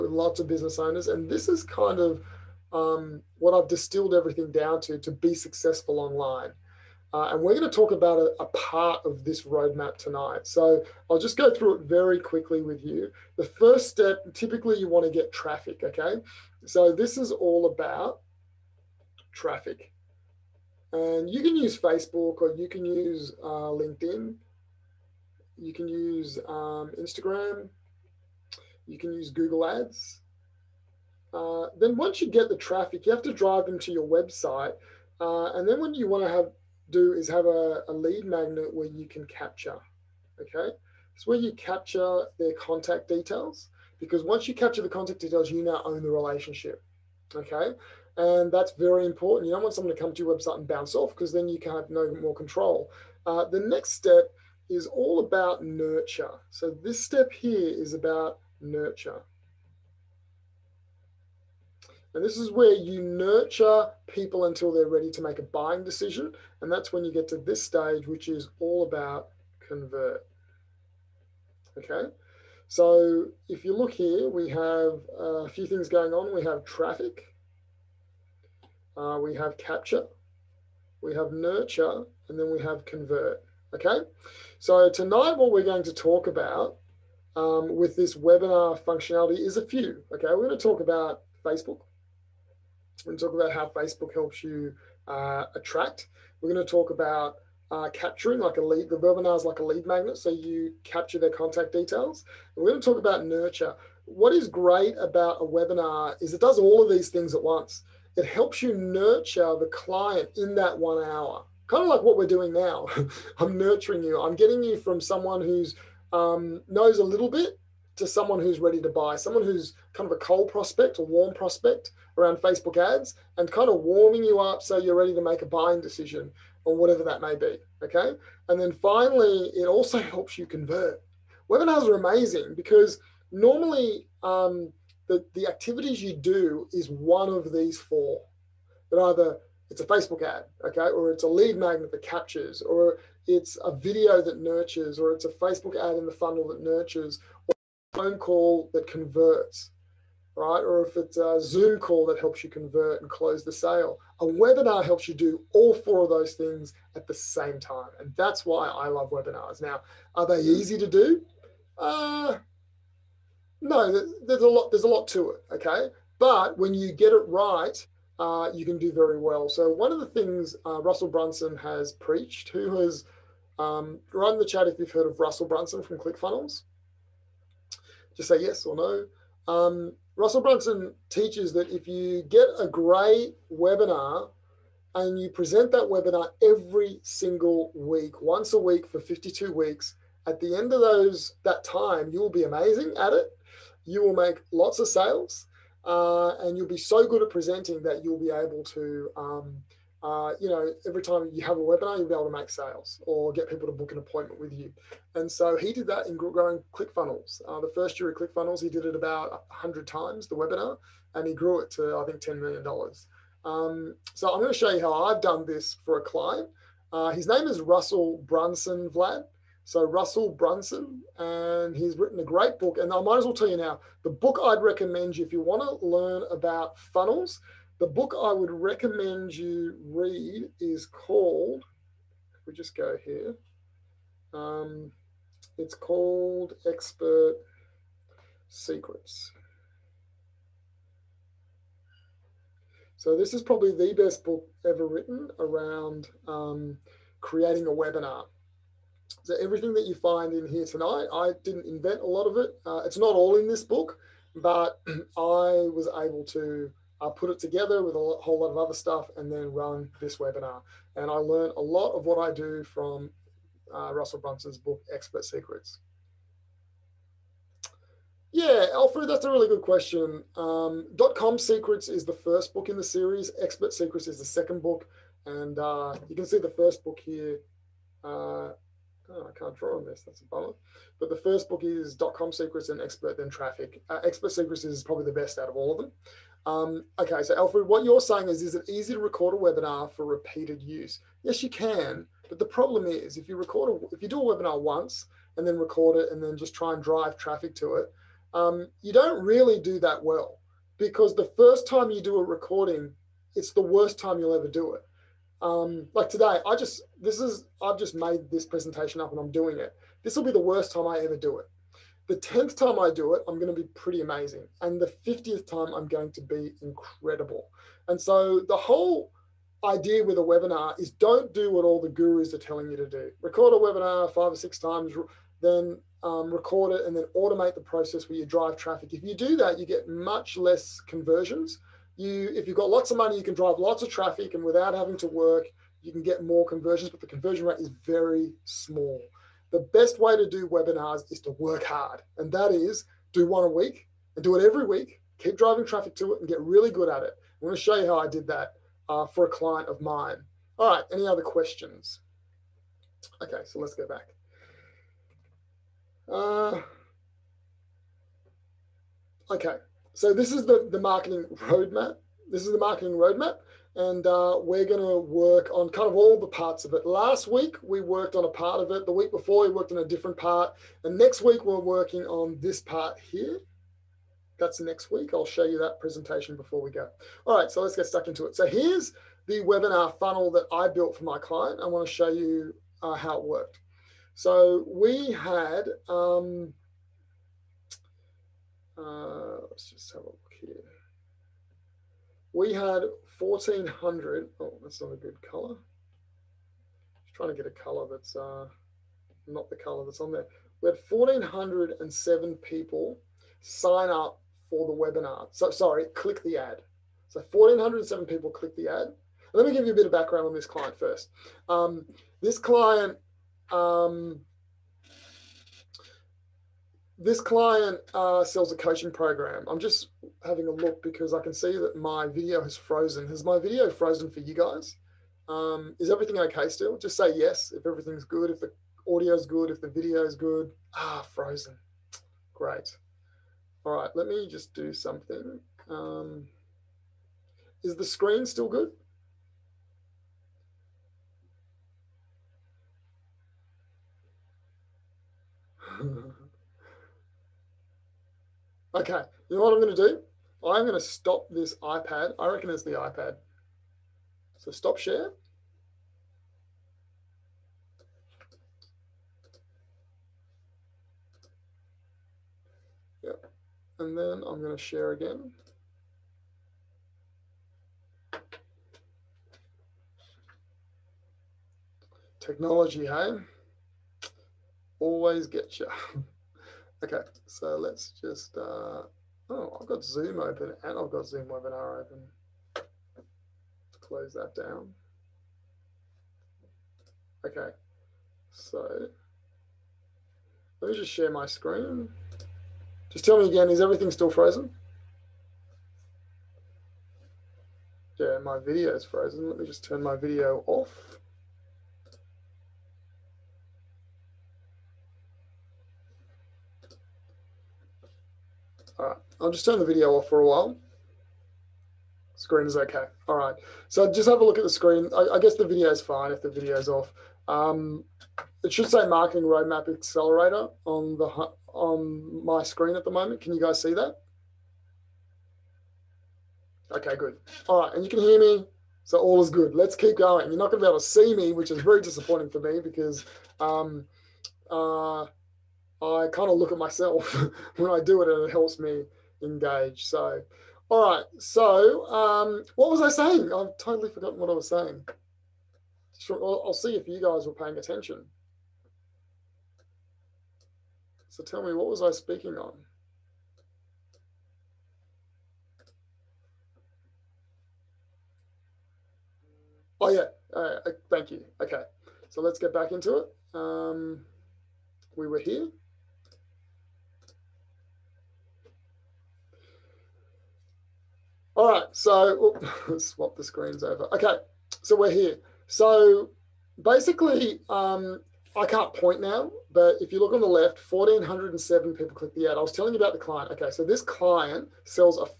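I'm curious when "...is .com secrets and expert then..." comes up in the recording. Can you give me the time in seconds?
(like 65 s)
281 s.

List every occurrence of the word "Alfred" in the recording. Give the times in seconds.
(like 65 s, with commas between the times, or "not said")
268 s, 287 s.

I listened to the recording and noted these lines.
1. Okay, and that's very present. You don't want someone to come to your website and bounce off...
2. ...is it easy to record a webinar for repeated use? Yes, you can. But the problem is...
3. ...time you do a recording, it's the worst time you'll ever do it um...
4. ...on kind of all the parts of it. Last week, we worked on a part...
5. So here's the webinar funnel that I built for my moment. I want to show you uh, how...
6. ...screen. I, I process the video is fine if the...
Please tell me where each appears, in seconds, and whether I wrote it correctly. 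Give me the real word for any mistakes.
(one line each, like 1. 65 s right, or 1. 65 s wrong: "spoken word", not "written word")
1. 47 s wrong: "important", not "present"
2. 288 s right
3. 301 s right
4. 365 s right
5. 378 s wrong: "client", not "moment"
6. 514 s wrong: "guess", not "process".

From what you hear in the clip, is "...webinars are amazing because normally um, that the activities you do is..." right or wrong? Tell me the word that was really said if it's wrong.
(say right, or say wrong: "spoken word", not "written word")
right.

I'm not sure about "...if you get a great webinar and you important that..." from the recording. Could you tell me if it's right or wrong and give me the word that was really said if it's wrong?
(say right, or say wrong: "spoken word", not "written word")
wrong: "present", not "important".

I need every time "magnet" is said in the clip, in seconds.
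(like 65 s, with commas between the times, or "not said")
38 s, 99 s, 141 s.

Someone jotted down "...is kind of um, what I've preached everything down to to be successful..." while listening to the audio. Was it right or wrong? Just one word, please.
wrong.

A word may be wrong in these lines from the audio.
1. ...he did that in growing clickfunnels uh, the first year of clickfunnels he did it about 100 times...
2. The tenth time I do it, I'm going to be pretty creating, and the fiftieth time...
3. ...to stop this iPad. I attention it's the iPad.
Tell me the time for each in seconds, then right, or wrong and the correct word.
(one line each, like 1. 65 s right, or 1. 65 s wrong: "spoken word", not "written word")
1. 205 s right
2. 312 s wrong: "amazing", not "creating"
3. 450 s wrong: "reckon", not "attention".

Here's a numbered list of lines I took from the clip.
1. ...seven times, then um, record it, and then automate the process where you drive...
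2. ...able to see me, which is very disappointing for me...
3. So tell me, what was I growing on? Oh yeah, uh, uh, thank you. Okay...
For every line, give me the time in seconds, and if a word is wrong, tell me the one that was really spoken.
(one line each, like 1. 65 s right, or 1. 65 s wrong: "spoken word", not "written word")
1. 324 s wrong: "six", not "seven"
2. 530 s right
3. 551 s wrong: "speaking", not "growing".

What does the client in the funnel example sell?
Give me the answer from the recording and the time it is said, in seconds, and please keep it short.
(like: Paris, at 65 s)
A coaching program, at 418 s.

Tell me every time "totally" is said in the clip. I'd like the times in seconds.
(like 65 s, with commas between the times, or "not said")
543 s.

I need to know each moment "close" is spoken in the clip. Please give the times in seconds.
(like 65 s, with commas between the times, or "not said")
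153 s, 483 s.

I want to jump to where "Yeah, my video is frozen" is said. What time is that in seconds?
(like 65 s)
497 s.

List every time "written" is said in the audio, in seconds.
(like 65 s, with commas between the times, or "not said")
221 s, 244 s.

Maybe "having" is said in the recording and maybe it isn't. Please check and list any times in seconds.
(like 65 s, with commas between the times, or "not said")
334 s, 420 s.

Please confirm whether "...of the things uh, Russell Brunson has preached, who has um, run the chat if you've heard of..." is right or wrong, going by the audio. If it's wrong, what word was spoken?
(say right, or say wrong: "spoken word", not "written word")
right.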